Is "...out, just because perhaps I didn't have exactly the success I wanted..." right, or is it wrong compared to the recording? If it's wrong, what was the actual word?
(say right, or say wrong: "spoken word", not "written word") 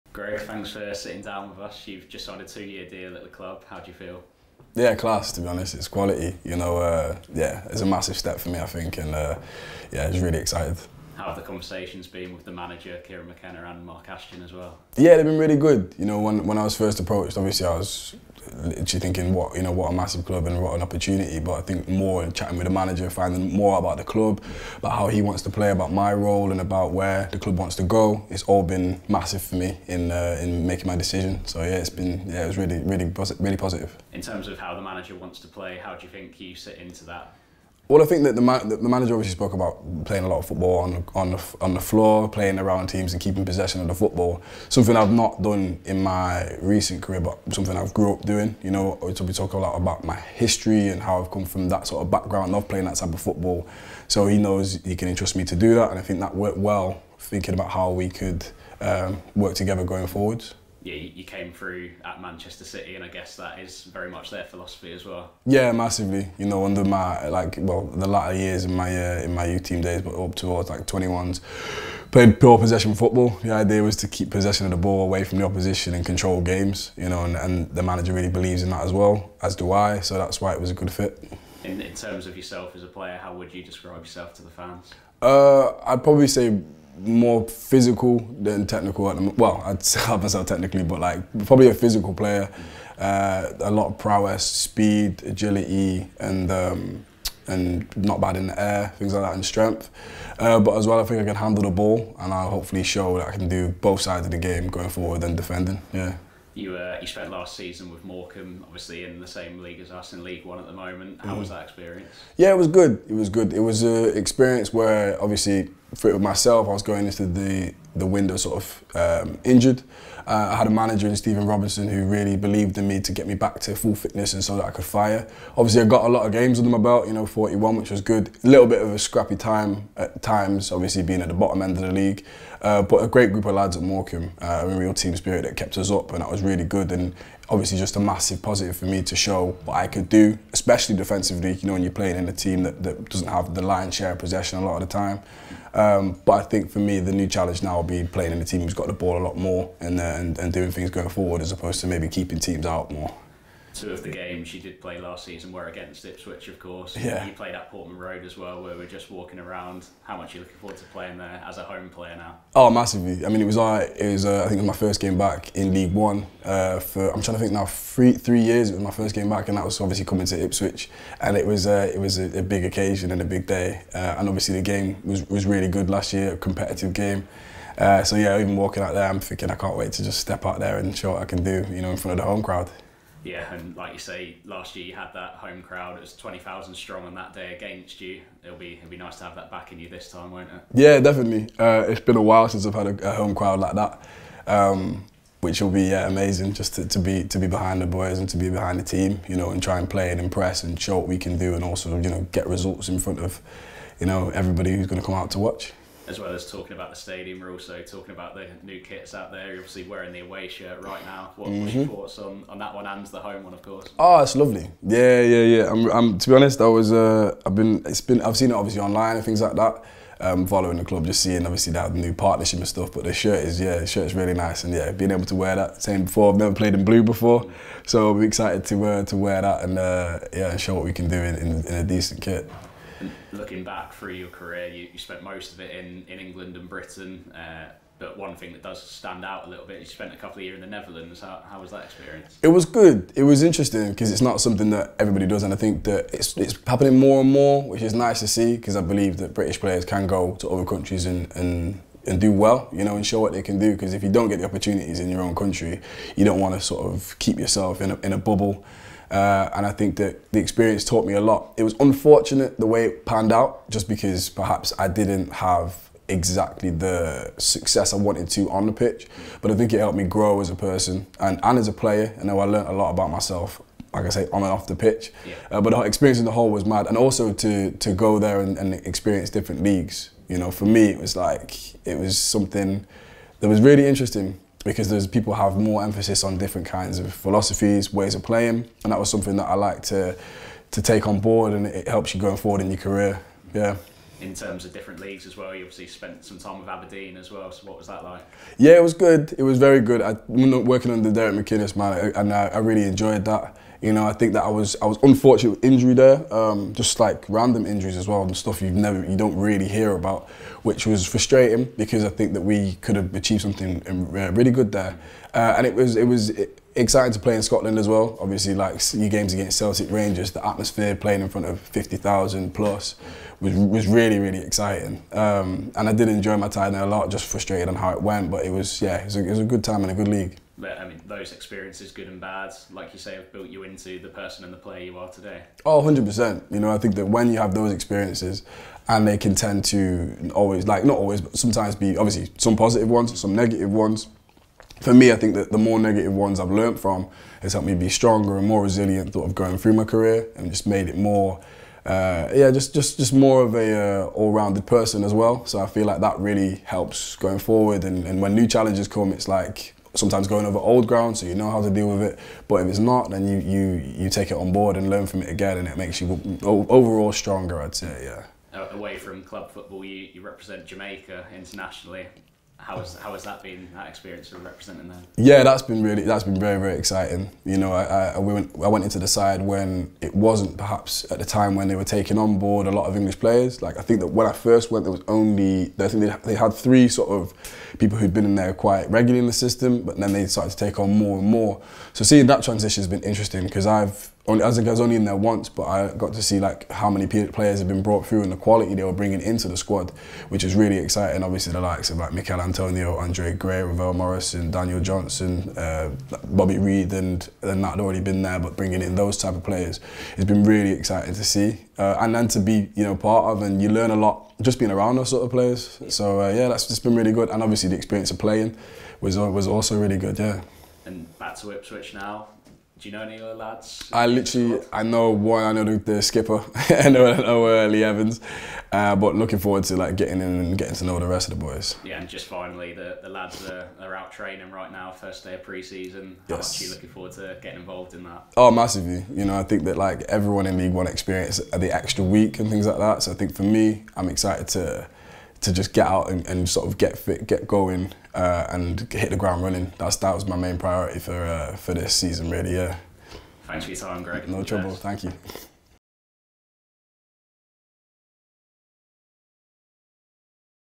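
right.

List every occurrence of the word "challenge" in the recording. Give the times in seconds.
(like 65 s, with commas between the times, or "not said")
147 s, 358 s.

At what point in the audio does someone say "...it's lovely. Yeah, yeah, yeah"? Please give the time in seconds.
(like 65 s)
214 s.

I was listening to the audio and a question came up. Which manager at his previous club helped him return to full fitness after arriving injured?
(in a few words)
Stephen Robinson.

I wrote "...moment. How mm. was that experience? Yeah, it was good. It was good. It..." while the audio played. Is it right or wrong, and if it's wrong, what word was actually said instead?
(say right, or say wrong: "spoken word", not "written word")
right.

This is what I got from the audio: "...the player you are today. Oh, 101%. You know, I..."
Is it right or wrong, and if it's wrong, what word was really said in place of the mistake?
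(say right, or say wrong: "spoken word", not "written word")
wrong: "100", not "101".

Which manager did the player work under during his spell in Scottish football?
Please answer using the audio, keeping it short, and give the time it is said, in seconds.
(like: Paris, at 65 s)
Derek McInnes, at 301 s.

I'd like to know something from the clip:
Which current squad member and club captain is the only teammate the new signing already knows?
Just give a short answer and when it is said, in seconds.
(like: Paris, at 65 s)
Lee Evans, at 427 s.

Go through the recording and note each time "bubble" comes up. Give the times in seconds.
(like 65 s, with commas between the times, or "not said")
258 s.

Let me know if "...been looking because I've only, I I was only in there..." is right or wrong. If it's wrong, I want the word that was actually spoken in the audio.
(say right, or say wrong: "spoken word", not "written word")
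wrong: "interesting", not "looking".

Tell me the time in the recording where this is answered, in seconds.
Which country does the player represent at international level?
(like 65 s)
370 s.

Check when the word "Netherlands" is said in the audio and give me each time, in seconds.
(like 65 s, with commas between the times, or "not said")
240 s.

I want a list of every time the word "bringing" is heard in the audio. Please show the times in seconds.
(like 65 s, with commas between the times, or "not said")
398 s, 408 s.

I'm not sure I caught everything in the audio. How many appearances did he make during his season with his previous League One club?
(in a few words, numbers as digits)
41.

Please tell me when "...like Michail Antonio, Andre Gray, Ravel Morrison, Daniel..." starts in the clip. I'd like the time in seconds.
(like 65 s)
401 s.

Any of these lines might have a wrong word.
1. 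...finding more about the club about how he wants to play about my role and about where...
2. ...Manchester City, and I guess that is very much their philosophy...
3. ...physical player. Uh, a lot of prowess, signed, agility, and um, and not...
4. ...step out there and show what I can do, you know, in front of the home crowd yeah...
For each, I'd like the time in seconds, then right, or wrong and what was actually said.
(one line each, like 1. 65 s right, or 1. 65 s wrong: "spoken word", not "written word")
1. 23 s right
2. 62 s right
3. 91 s wrong: "speed", not "signed"
4. 180 s right.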